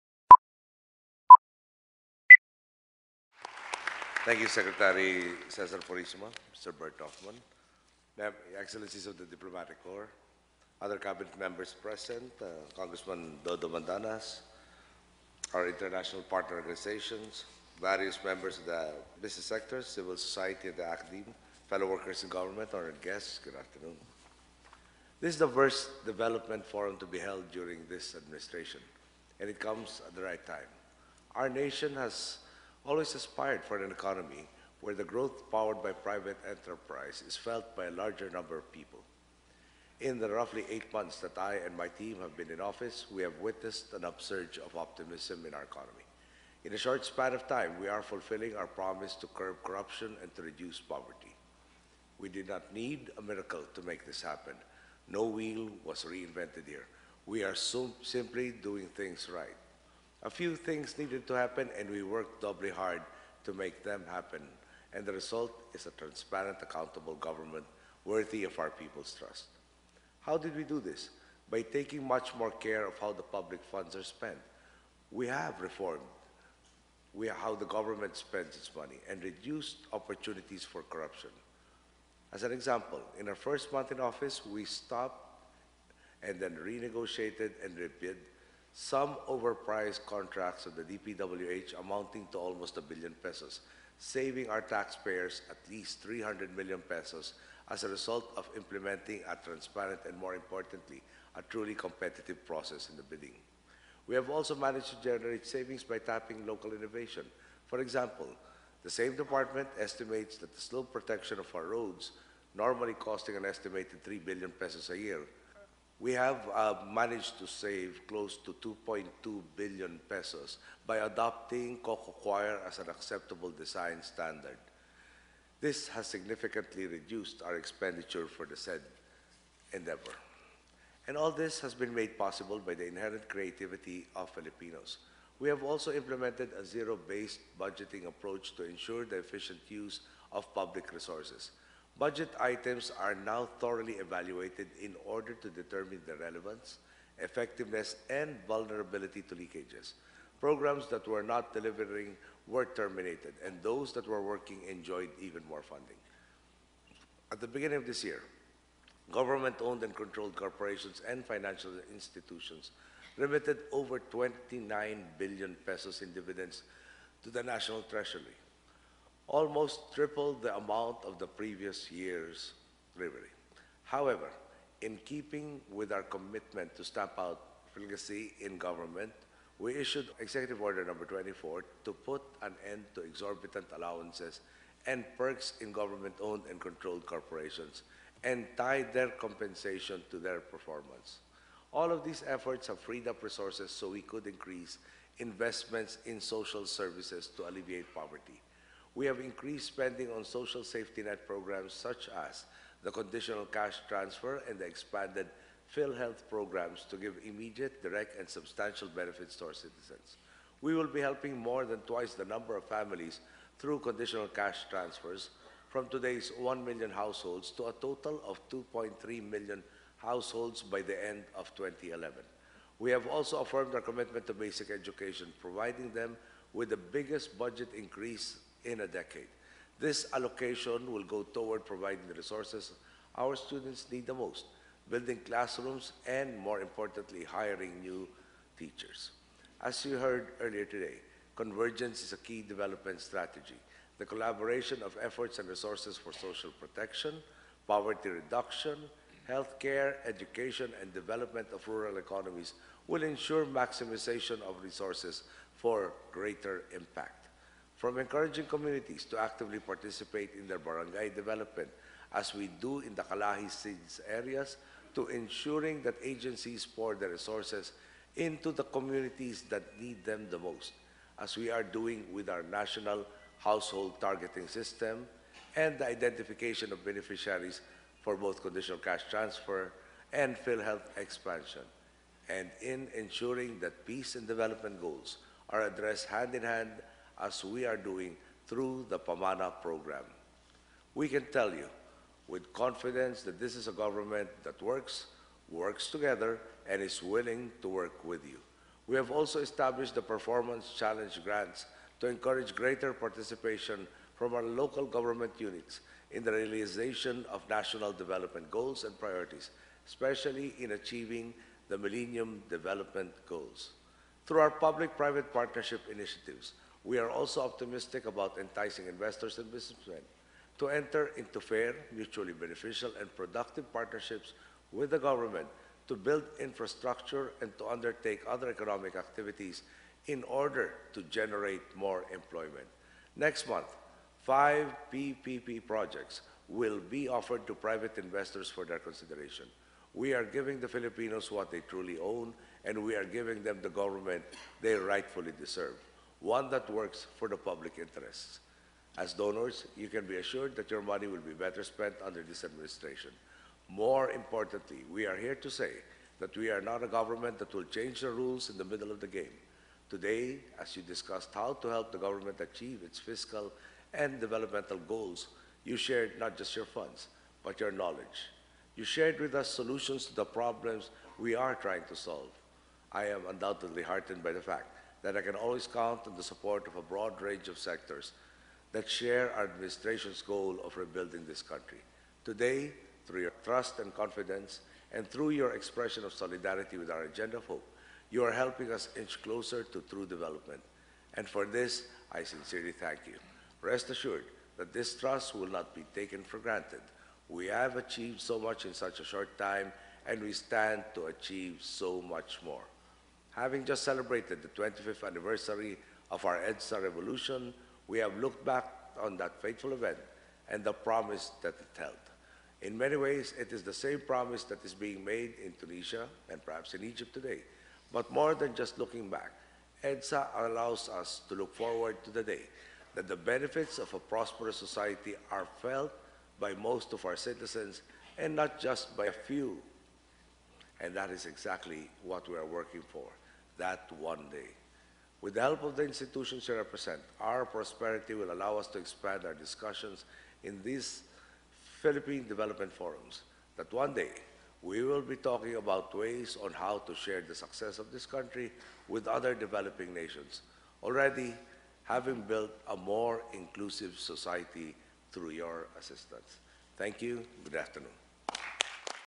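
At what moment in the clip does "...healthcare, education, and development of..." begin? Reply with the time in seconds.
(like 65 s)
249 s.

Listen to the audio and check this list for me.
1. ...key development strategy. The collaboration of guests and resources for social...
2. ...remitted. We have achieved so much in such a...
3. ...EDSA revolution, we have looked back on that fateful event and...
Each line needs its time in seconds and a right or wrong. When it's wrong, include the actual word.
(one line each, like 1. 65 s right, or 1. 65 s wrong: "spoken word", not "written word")
1. 242 s wrong: "efforts", not "guests"
2. 396 s wrong: "granted", not "remitted"
3. 406 s right.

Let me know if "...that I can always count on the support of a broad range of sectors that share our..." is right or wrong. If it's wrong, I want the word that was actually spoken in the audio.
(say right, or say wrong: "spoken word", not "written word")
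right.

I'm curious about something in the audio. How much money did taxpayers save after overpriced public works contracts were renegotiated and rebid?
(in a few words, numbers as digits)
300 million pesos.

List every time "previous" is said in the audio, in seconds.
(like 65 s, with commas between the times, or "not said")
171 s.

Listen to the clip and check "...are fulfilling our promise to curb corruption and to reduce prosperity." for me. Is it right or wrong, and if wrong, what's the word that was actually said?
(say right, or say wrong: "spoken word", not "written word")
wrong: "poverty", not "prosperity".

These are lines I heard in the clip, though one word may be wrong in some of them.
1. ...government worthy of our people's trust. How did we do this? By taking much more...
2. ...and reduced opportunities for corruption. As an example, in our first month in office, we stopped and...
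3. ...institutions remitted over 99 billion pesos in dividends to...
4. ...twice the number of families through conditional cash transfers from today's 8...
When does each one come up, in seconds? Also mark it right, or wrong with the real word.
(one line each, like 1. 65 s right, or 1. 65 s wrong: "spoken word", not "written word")
1. 67 s right
2. 79 s right
3. 161 s wrong: "29", not "99"
4. 211 s wrong: "1", not "8".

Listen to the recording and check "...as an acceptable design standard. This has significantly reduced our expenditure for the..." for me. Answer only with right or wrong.
right.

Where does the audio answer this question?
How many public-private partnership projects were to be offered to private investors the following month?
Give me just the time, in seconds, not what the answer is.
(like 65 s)
334 s.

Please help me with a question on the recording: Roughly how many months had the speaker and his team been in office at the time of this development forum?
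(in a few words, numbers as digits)
8 months.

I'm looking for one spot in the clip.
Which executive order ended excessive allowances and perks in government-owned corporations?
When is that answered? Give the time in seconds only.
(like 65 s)
180 s.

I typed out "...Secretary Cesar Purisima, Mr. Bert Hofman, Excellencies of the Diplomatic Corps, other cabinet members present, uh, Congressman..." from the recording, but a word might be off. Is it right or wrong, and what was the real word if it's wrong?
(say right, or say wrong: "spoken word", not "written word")
right.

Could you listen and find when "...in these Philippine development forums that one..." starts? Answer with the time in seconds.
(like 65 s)
440 s.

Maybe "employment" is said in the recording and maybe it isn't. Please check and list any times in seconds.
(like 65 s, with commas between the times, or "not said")
332 s.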